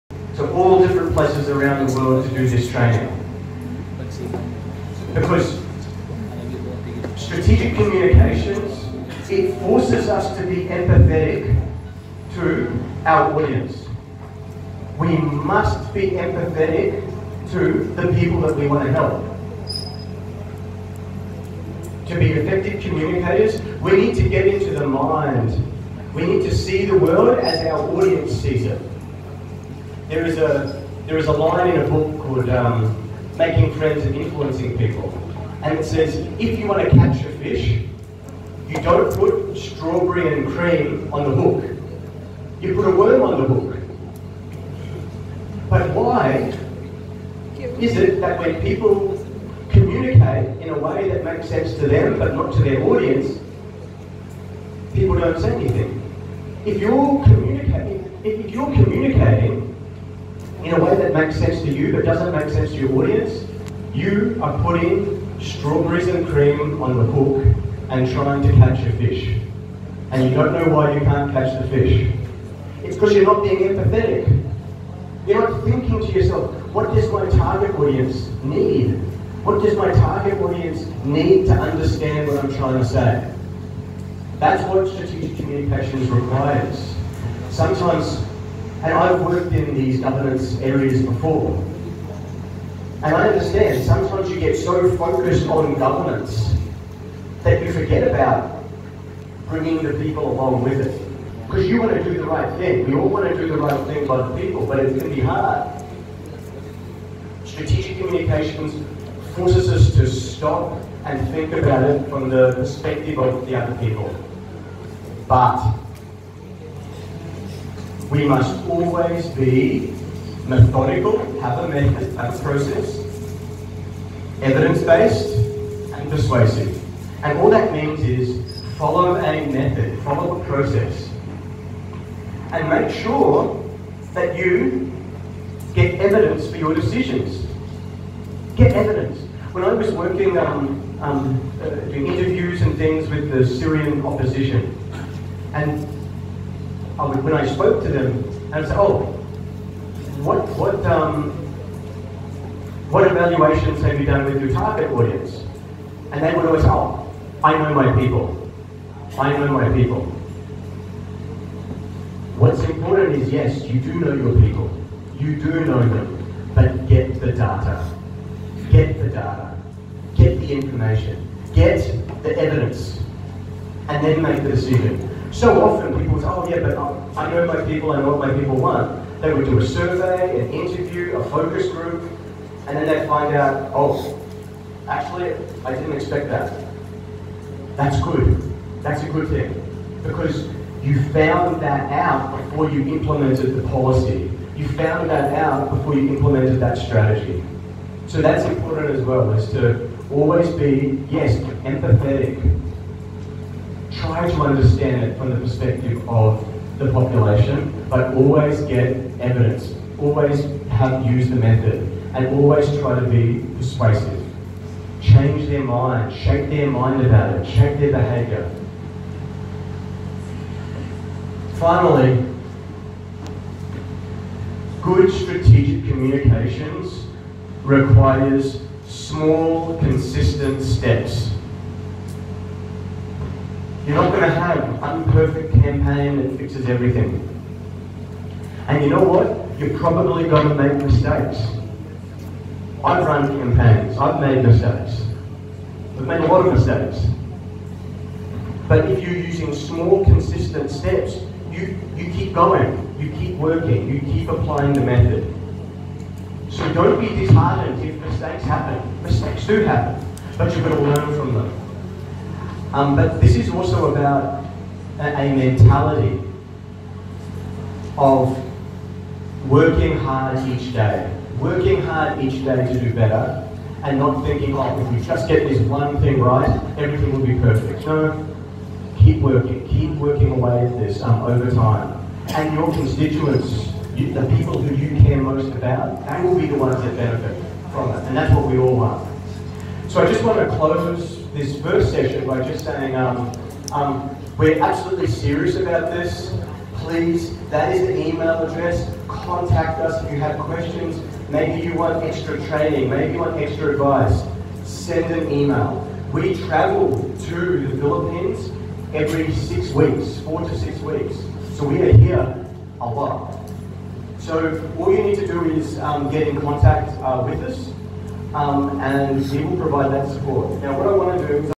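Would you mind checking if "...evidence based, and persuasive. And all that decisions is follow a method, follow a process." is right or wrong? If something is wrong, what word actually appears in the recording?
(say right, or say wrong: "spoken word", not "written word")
wrong: "means", not "decisions".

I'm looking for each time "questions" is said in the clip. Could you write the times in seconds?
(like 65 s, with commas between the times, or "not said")
300 s.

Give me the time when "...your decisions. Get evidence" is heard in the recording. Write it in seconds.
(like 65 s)
136 s.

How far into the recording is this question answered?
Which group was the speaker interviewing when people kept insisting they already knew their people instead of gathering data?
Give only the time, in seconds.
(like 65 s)
143 s.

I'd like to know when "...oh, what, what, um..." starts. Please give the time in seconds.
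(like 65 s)
148 s.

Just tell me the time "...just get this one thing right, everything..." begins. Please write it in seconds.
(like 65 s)
275 s.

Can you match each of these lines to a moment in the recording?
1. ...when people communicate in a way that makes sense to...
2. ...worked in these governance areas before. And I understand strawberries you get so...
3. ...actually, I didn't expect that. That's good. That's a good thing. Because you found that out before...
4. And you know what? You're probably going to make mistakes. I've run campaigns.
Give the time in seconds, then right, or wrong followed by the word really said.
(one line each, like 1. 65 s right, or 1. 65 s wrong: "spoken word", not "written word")
1. 48 s right
2. 89 s wrong: "sometimes", not "strawberries"
3. 184 s right
4. 238 s right.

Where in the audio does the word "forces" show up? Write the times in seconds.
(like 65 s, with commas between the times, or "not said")
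9 s, 109 s.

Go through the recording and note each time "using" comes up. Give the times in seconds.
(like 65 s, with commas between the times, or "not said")
249 s.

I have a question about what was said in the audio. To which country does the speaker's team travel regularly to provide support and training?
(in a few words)
Philippines.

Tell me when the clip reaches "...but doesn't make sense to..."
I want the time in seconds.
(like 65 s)
61 s.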